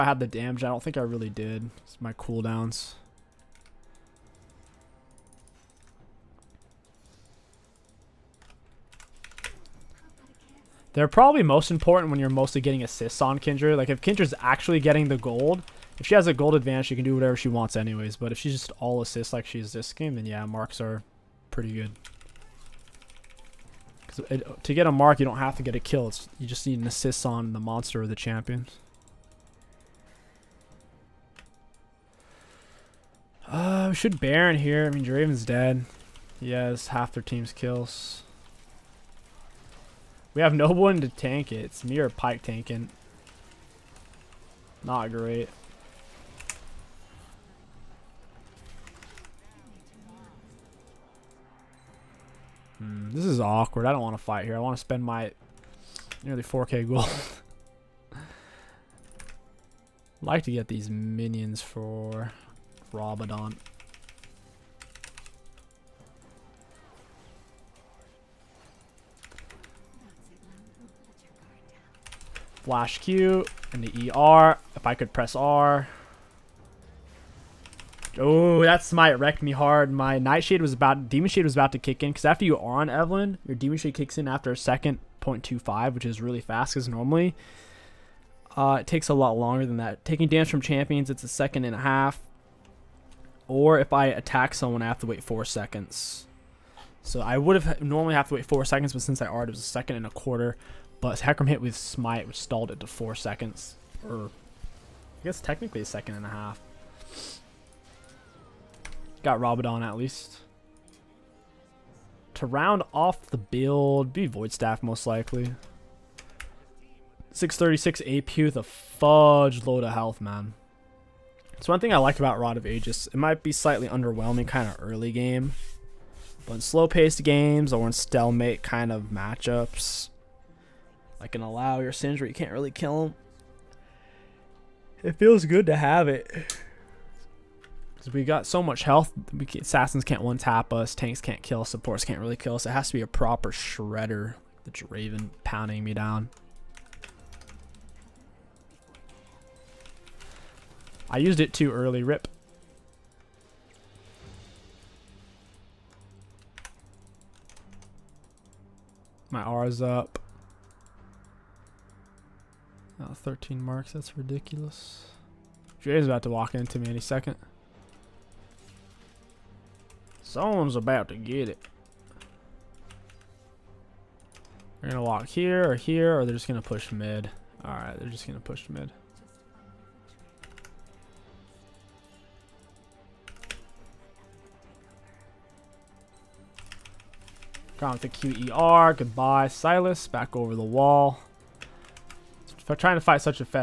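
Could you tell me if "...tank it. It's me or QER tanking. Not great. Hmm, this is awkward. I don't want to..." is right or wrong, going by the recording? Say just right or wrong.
wrong.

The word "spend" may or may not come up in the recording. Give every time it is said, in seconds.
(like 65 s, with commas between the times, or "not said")
54 s.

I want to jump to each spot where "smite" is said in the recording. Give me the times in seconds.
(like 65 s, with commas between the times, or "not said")
78 s, 101 s.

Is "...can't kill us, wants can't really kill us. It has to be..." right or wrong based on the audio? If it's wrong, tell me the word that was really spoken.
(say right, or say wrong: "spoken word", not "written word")
wrong: "supports", not "wants".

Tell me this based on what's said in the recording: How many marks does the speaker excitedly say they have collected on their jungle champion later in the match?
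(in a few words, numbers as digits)
13.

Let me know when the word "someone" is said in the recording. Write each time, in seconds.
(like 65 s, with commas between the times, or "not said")
94 s, 170 s.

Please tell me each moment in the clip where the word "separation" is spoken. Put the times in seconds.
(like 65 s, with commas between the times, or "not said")
not said.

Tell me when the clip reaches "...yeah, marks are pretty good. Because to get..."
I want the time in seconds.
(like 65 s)
20 s.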